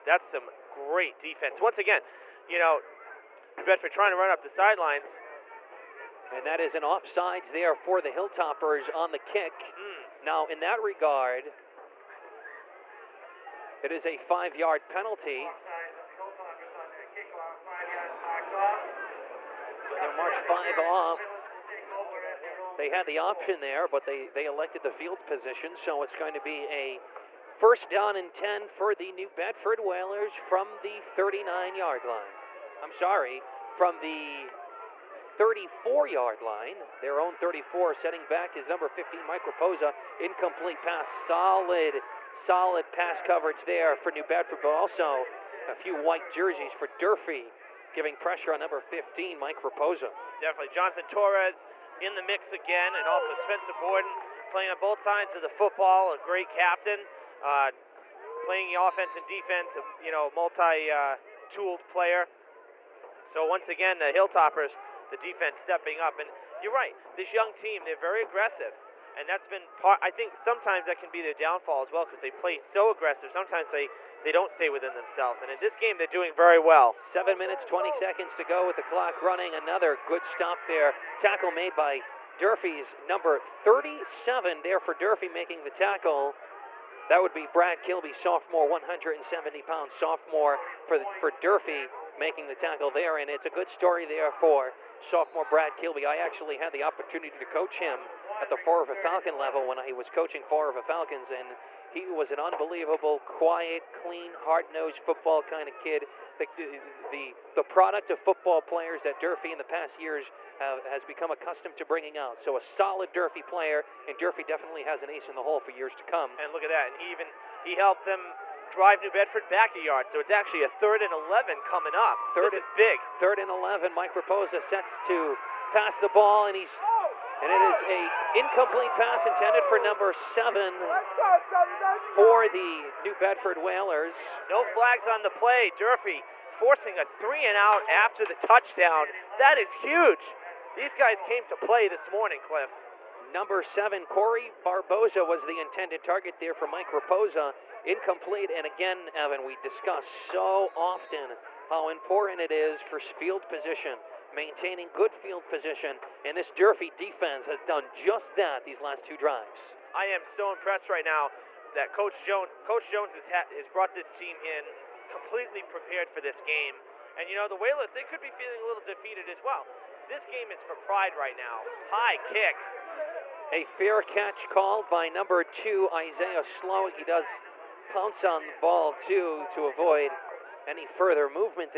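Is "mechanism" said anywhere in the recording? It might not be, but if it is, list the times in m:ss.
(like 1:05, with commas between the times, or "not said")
not said.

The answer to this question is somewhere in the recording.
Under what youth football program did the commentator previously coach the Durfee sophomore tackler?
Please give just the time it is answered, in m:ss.
1:38.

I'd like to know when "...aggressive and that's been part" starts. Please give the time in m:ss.
1:08.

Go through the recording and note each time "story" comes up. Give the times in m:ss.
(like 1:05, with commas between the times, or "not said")
1:33.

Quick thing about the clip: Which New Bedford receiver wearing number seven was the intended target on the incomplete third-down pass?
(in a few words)
Corey Barboza.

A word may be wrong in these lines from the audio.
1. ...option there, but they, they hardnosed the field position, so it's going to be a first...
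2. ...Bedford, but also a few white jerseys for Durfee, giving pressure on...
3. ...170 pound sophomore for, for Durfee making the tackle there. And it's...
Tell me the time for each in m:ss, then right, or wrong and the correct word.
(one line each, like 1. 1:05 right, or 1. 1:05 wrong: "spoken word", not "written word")
1. 0:23 wrong: "elected", not "hardnosed"
2. 0:44 right
3. 1:28 right.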